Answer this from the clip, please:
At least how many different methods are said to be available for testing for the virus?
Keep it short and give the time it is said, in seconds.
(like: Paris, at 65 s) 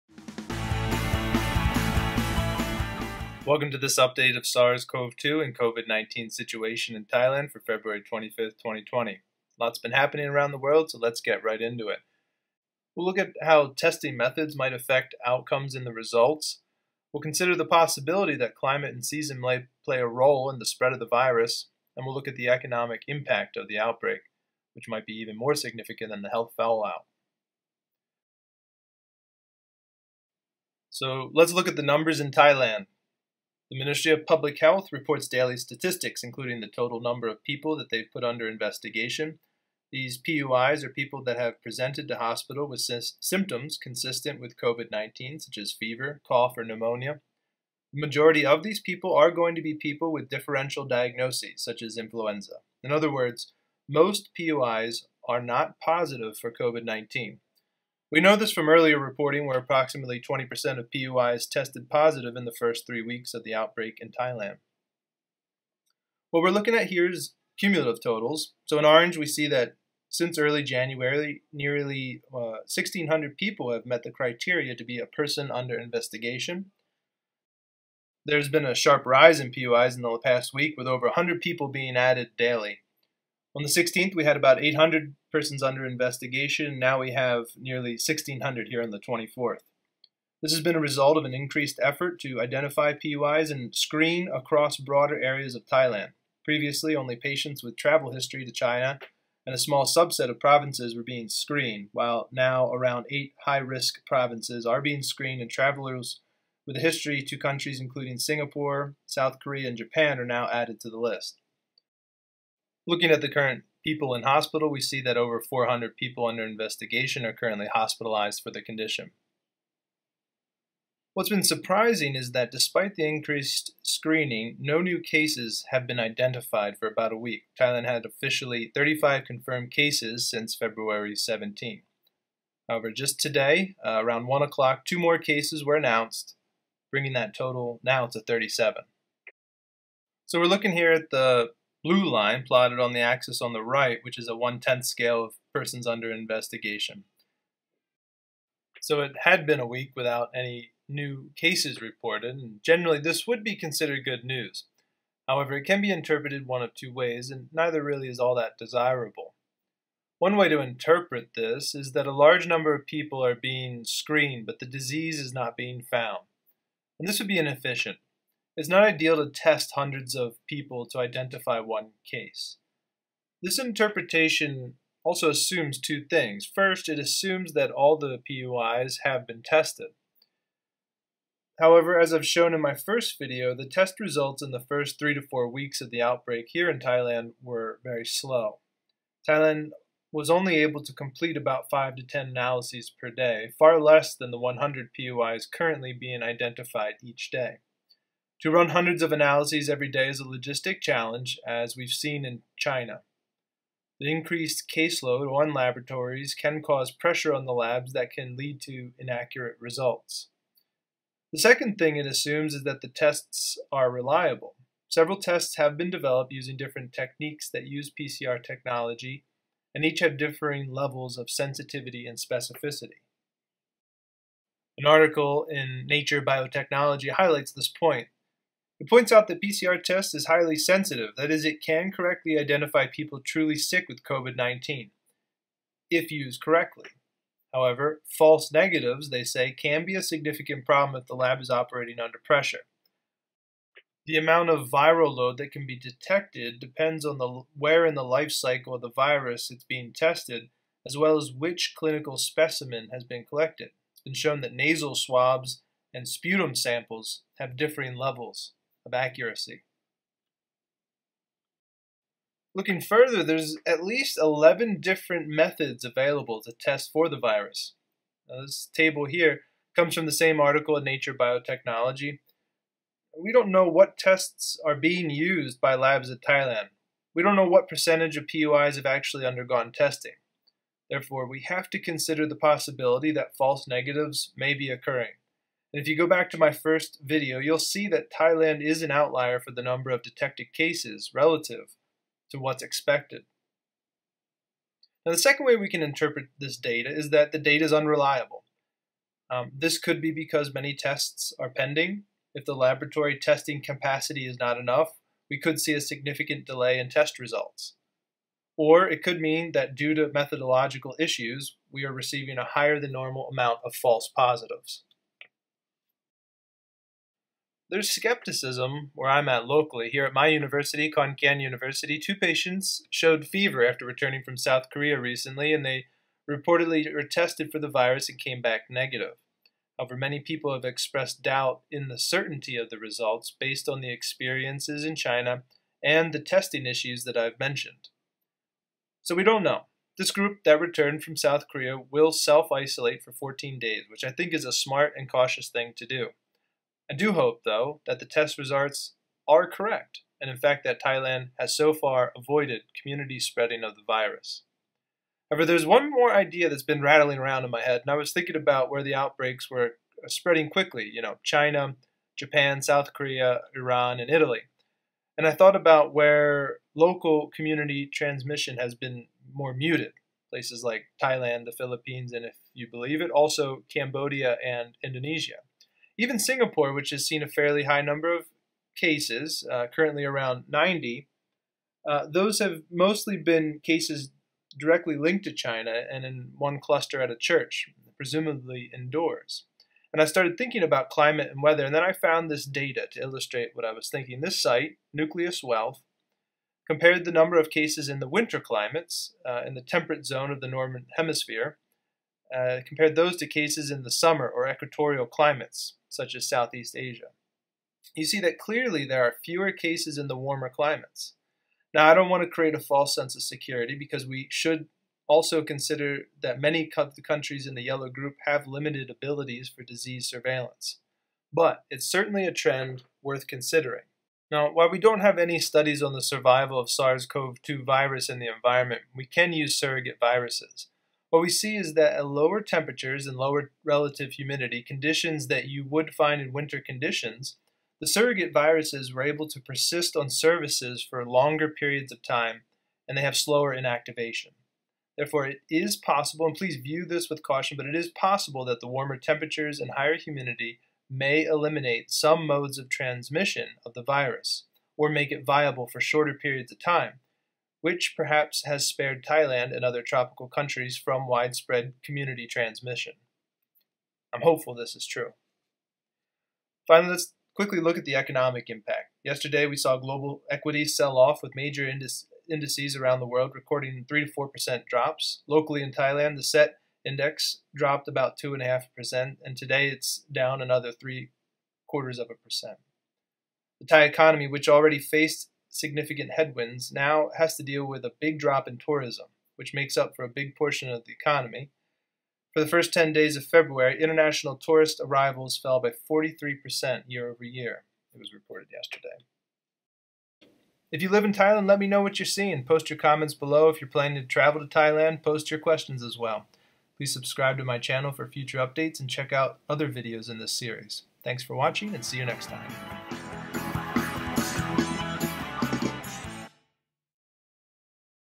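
11, at 263 s.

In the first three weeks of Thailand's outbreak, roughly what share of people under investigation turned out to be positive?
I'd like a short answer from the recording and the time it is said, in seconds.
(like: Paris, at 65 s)
20%, at 59 s.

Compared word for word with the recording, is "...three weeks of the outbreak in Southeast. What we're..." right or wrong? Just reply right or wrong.
wrong.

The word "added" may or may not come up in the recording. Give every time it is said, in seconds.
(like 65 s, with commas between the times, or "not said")
81 s, 110 s.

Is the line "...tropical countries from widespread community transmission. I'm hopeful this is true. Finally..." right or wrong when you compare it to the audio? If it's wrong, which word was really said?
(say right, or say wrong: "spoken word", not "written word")
right.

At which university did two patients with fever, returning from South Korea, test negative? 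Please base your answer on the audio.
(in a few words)
Khon Kaen University.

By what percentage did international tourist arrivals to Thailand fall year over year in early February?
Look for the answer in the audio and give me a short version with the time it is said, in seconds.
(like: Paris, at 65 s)
43%, at 495 s.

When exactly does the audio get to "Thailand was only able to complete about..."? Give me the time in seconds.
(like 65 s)
189 s.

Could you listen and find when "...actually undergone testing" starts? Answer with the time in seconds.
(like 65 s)
278 s.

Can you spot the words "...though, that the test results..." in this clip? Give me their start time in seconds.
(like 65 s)
347 s.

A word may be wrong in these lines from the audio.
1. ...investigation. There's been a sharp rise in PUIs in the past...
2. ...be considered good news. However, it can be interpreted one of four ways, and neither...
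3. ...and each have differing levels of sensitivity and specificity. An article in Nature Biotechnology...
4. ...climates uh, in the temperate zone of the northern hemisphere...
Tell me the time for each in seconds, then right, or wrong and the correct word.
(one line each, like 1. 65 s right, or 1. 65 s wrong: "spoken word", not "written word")
1. 75 s right
2. 153 s wrong: "two", not "four"
3. 219 s right
4. 398 s right.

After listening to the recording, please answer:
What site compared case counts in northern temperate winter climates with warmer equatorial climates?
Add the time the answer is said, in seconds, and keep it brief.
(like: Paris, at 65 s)
Nucleus Wealth, at 394 s.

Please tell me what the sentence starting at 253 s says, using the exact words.
It's been shown that nasal swabs and sputum samples have differing levels of accuracy.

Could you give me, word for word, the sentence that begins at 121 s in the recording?
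What's been surprising is that despite the increased screening, no new cases have been identified for about a week.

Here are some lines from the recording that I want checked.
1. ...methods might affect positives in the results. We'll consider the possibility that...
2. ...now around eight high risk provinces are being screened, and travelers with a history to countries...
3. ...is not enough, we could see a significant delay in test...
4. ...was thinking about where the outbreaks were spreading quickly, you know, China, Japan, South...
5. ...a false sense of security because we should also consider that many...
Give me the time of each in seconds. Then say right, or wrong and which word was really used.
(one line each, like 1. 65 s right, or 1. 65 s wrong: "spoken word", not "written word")
1. 14 s wrong: "outcomes", not "positives"
2. 102 s right
3. 304 s right
4. 357 s right
5. 412 s right.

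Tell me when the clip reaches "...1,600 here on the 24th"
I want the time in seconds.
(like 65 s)
87 s.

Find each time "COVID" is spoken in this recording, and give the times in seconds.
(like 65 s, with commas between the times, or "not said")
5 s, 44 s, 56 s, 234 s.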